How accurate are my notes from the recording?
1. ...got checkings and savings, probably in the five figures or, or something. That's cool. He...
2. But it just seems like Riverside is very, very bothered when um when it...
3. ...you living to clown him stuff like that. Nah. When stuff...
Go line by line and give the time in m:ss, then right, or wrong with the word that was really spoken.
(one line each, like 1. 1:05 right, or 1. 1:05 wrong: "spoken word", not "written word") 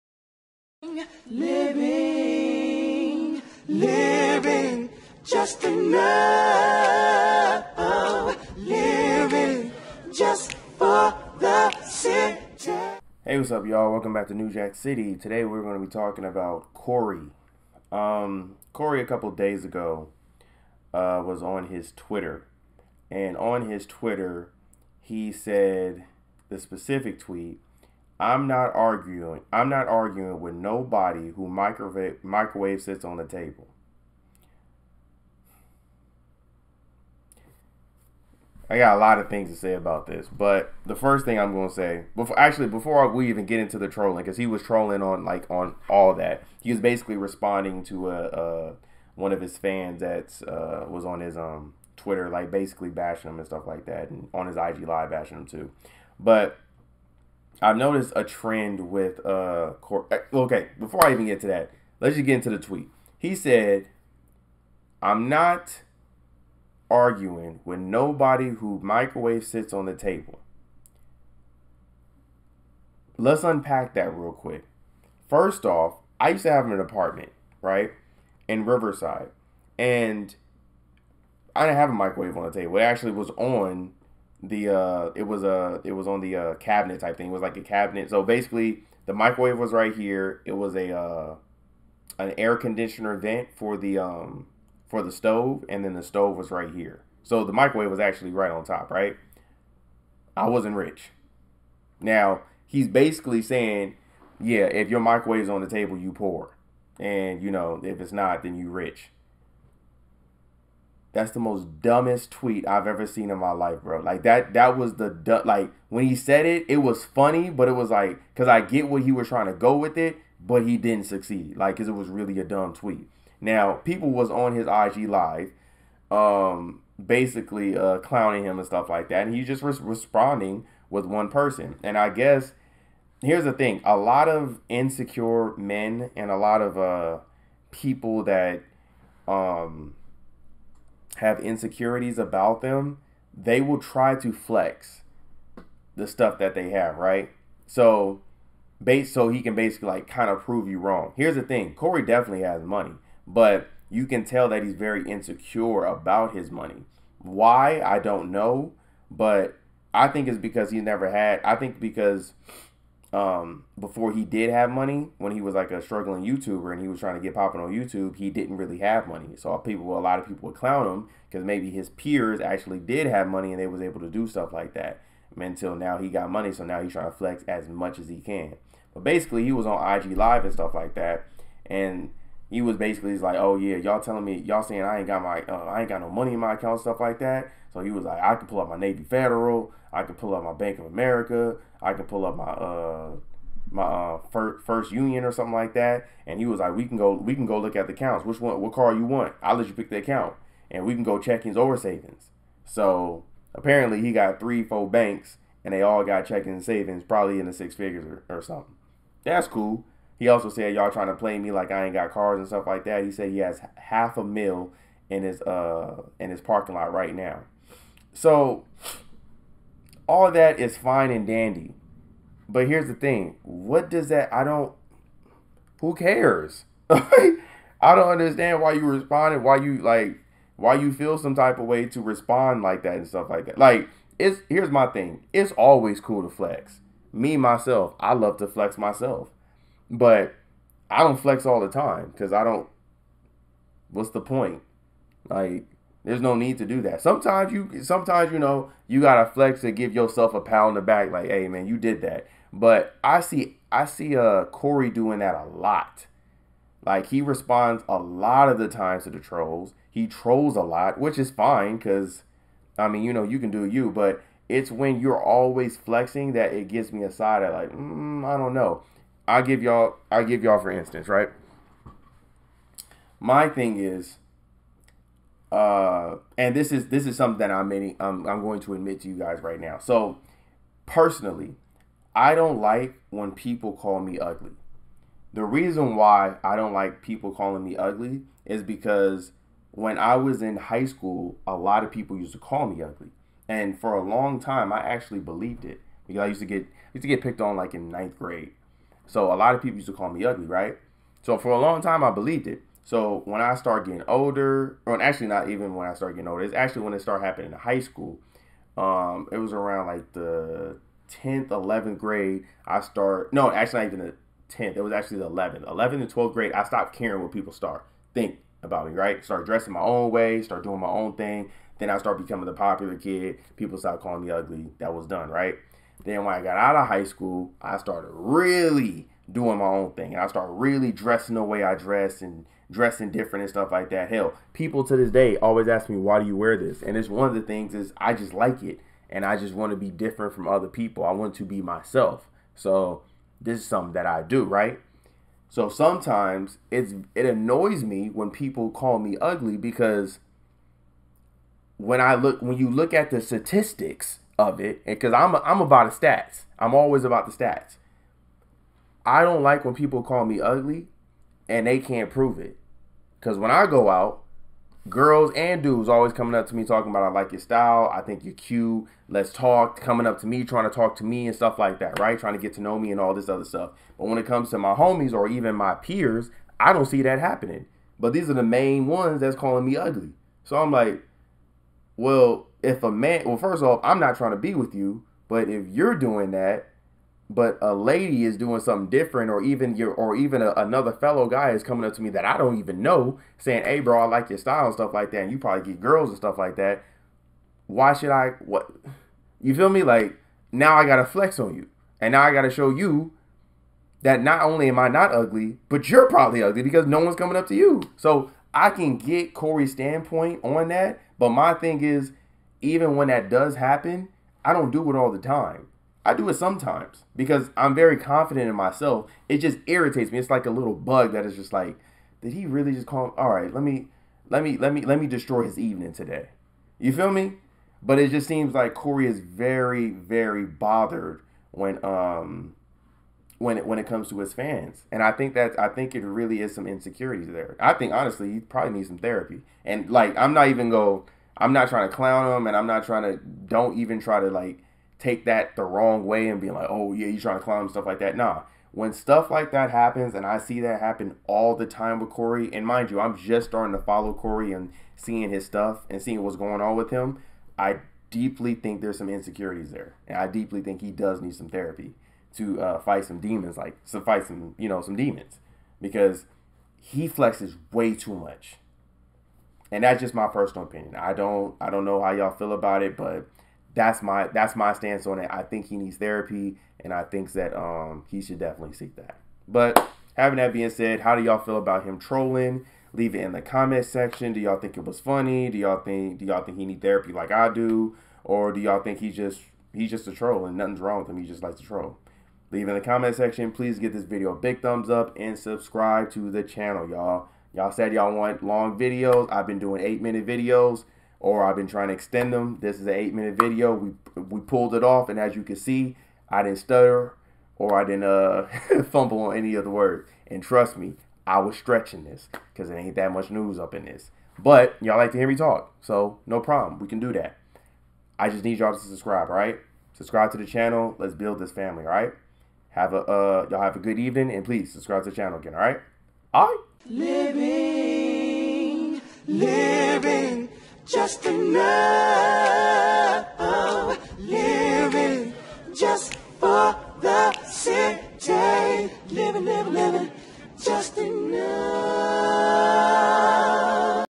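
1. 3:26 wrong: "six", not "five"
2. 7:07 wrong: "Corey", not "Riverside"
3. 7:27 wrong: "trying", not "living".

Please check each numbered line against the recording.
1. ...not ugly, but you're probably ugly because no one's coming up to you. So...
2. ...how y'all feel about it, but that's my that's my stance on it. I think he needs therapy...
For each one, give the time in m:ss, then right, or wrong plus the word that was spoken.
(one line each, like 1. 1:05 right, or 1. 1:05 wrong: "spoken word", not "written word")
1. 6:44 right
2. 7:52 right.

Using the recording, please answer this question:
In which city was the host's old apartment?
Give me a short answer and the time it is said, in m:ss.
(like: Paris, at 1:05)
Riverside, at 1:18.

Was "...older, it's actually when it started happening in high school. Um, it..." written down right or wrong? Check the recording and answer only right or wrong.
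right.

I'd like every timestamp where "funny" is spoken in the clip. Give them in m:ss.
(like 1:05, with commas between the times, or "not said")
1:57, 8:04.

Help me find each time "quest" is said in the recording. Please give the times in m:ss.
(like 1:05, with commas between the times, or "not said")
not said.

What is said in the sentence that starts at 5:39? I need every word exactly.
And I just want to be different from other people.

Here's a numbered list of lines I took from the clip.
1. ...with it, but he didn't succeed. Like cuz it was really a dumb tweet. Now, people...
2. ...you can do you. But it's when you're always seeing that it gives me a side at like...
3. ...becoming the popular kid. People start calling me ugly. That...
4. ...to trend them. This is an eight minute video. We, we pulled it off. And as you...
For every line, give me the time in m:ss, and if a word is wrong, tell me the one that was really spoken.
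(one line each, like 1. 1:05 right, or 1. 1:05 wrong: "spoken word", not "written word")
1. 1:59 right
2. 4:23 wrong: "flexing", not "seeing"
3. 5:22 right
4. 8:21 wrong: "extend", not "trend".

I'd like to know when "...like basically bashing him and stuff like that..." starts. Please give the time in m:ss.
0:52.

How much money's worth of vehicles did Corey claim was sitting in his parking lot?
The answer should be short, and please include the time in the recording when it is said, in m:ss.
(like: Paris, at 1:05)
Half a mil, at 3:33.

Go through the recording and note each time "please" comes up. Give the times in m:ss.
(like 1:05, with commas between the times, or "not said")
8:13, 8:44.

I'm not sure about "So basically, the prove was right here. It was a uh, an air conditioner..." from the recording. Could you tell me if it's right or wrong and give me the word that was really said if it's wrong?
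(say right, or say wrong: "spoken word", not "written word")
wrong: "microwave", not "prove".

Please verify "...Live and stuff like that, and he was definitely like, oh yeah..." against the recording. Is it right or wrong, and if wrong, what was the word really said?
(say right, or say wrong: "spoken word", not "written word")
wrong: "basically", not "definitely".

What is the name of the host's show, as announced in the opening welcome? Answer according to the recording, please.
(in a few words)
New Jack City.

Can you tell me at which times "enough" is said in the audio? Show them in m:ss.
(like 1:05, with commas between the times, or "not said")
0:05, 8:51.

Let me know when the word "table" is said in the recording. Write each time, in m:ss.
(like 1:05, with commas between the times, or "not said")
0:33, 1:09, 1:22, 1:45.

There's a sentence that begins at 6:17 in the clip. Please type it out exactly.
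But these are the main ones that's calling me ugly.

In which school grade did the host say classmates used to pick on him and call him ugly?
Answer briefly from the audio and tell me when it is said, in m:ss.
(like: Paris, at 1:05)
Ninth grade, at 4:57.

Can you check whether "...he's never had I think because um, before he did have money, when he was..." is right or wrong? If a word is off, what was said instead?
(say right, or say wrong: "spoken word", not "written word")
right.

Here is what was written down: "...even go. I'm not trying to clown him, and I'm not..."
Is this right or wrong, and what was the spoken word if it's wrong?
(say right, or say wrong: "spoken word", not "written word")
right.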